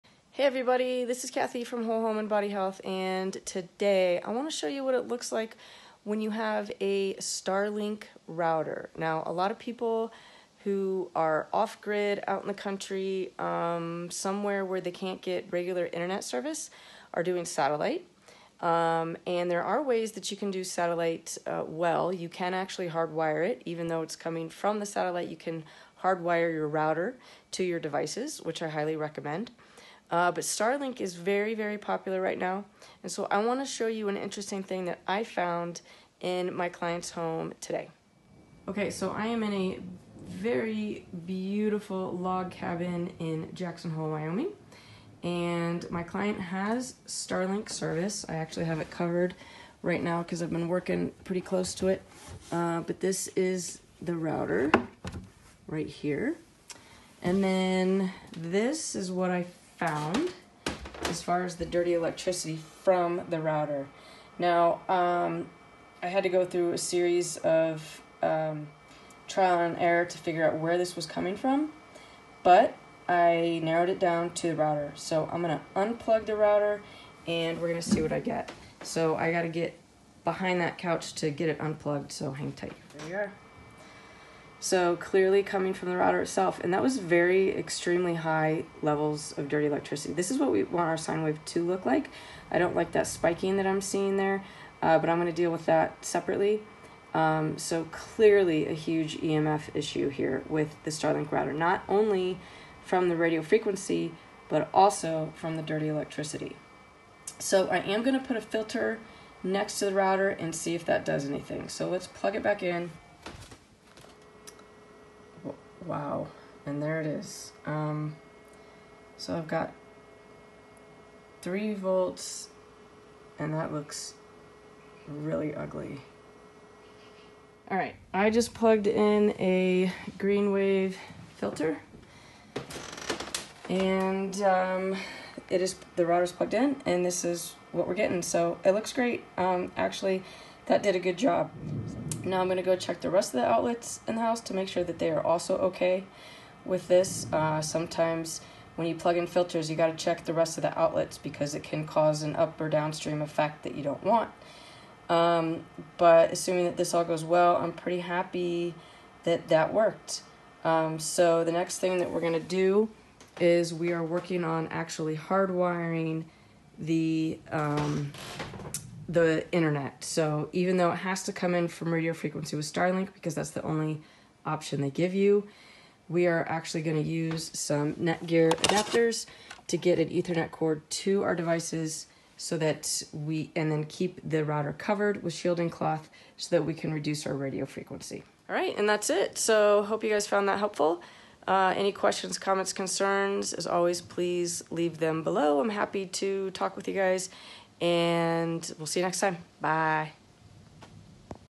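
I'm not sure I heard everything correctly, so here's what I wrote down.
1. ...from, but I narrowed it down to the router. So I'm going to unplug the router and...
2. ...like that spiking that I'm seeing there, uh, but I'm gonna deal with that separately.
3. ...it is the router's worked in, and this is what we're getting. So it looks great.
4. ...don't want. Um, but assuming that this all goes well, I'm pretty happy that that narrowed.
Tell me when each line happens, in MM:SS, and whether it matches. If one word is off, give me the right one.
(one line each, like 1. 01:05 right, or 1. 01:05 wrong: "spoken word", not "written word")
1. 01:11 right
2. 01:32 right
3. 02:15 wrong: "plugged", not "worked"
4. 02:33 wrong: "worked", not "narrowed".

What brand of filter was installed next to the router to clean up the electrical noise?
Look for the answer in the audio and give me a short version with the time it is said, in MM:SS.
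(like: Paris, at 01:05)
Greenwave, at 02:10.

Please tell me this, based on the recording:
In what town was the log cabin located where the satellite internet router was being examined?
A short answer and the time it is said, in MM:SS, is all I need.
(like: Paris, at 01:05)
Jackson Hole, Wyoming, at 00:43.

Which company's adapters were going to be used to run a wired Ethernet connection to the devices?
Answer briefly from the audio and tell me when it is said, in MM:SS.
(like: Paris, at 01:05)
Netgear, at 02:57.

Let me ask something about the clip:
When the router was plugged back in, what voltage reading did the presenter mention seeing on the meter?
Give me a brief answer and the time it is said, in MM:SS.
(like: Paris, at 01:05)
3 volts, at 02:01.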